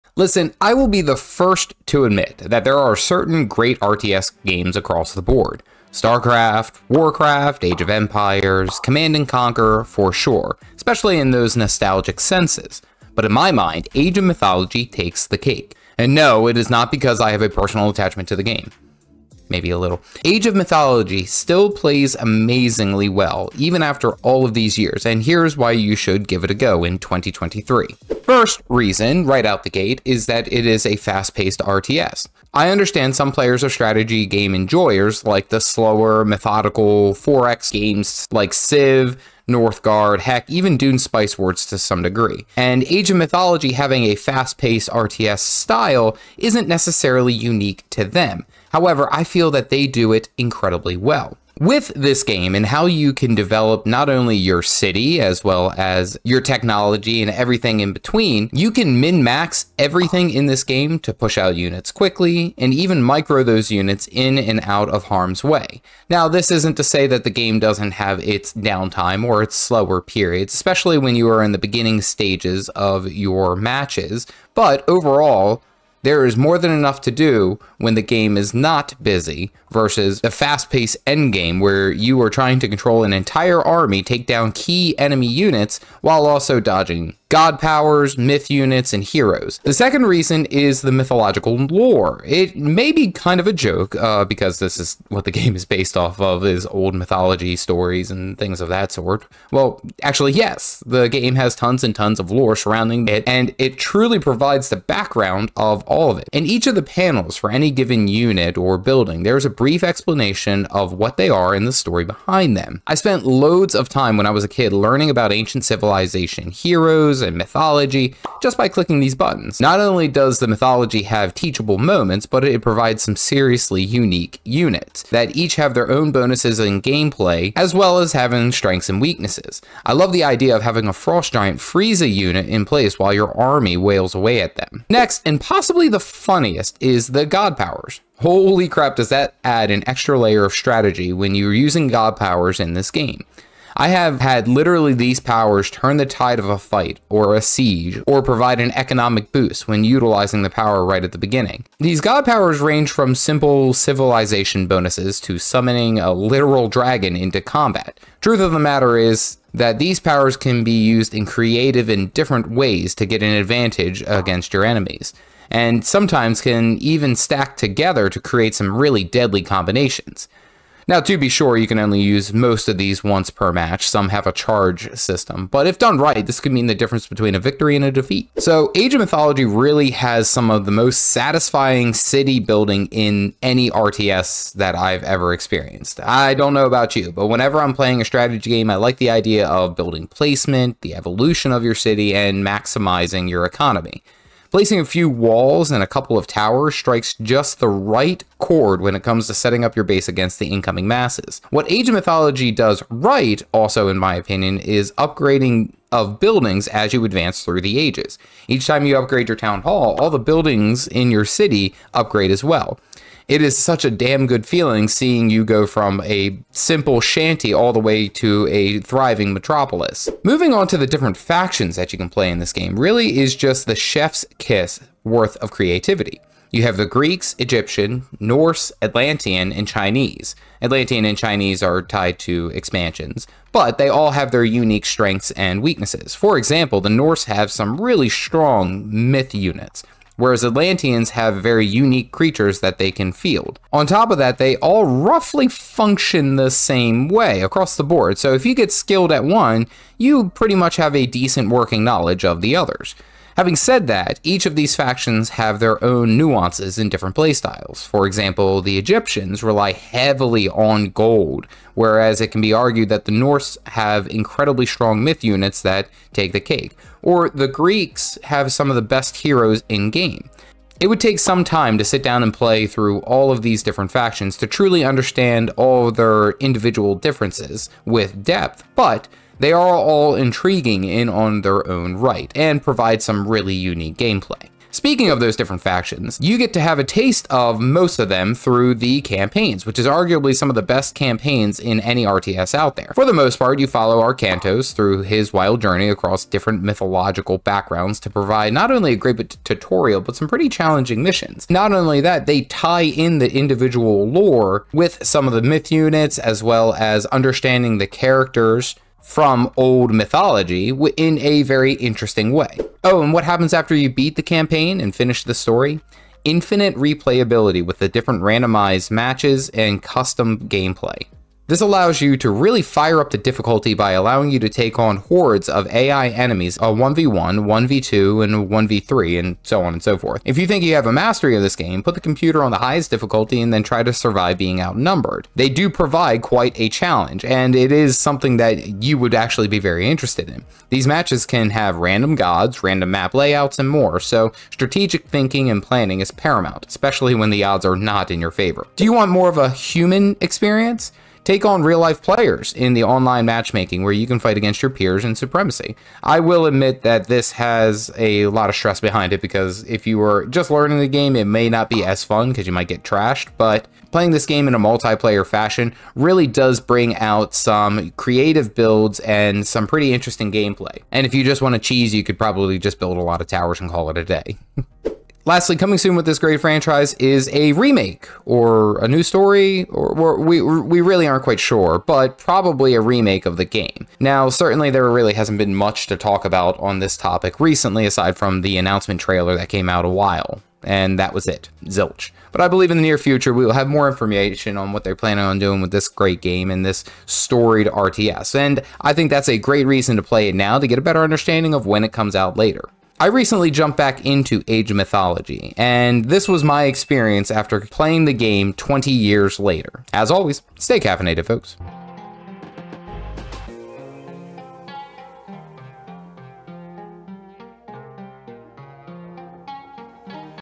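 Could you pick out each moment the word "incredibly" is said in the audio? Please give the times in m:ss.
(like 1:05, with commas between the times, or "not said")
0:50, 4:24.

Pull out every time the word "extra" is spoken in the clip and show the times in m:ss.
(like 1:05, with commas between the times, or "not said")
2:19.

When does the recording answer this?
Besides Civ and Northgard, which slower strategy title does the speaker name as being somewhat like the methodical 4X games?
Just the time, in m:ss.
0:40.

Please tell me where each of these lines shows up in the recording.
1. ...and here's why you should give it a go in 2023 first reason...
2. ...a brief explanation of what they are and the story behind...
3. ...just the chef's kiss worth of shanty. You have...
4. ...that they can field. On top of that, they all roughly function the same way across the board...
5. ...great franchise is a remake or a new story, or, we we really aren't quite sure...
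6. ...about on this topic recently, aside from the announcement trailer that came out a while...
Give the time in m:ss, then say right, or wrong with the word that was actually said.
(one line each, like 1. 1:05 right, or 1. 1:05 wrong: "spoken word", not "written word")
1. 0:25 right
2. 1:49 right
3. 3:43 wrong: "creativity", not "shanty"
4. 4:02 right
5. 6:16 right
6. 6:26 right.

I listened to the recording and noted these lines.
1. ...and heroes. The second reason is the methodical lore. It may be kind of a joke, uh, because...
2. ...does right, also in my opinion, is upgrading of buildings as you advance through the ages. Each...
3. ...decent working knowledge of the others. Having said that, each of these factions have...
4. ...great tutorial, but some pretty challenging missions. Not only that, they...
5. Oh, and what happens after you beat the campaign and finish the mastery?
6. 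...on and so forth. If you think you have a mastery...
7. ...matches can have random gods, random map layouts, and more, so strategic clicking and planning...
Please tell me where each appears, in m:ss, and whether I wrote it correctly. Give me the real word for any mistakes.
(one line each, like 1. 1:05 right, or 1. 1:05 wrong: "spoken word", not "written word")
1. 1:28 wrong: "mythological", not "methodical"
2. 3:22 right
3. 4:11 right
4. 4:58 right
5. 5:12 wrong: "story", not "mastery"
6. 5:29 right
7. 5:40 wrong: "thinking", not "clicking".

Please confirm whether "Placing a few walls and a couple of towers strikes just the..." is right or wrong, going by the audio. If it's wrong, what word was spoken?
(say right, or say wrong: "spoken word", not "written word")
right.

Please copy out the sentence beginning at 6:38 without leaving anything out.
And I think that's a great reason to play it now to get a better understanding of when it comes out later.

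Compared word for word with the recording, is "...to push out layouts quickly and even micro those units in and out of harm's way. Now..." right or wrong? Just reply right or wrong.
wrong.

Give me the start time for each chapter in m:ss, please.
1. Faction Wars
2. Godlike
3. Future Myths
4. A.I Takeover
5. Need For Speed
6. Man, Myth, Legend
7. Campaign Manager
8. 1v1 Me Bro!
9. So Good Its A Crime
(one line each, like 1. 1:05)
1. 3:40
2. 2:14
3. 6:15
4. 5:12
5. 0:28
6. 1:29
7. 4:44
8. 5:48
9. 2:58.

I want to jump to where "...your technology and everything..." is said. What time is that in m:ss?
0:56.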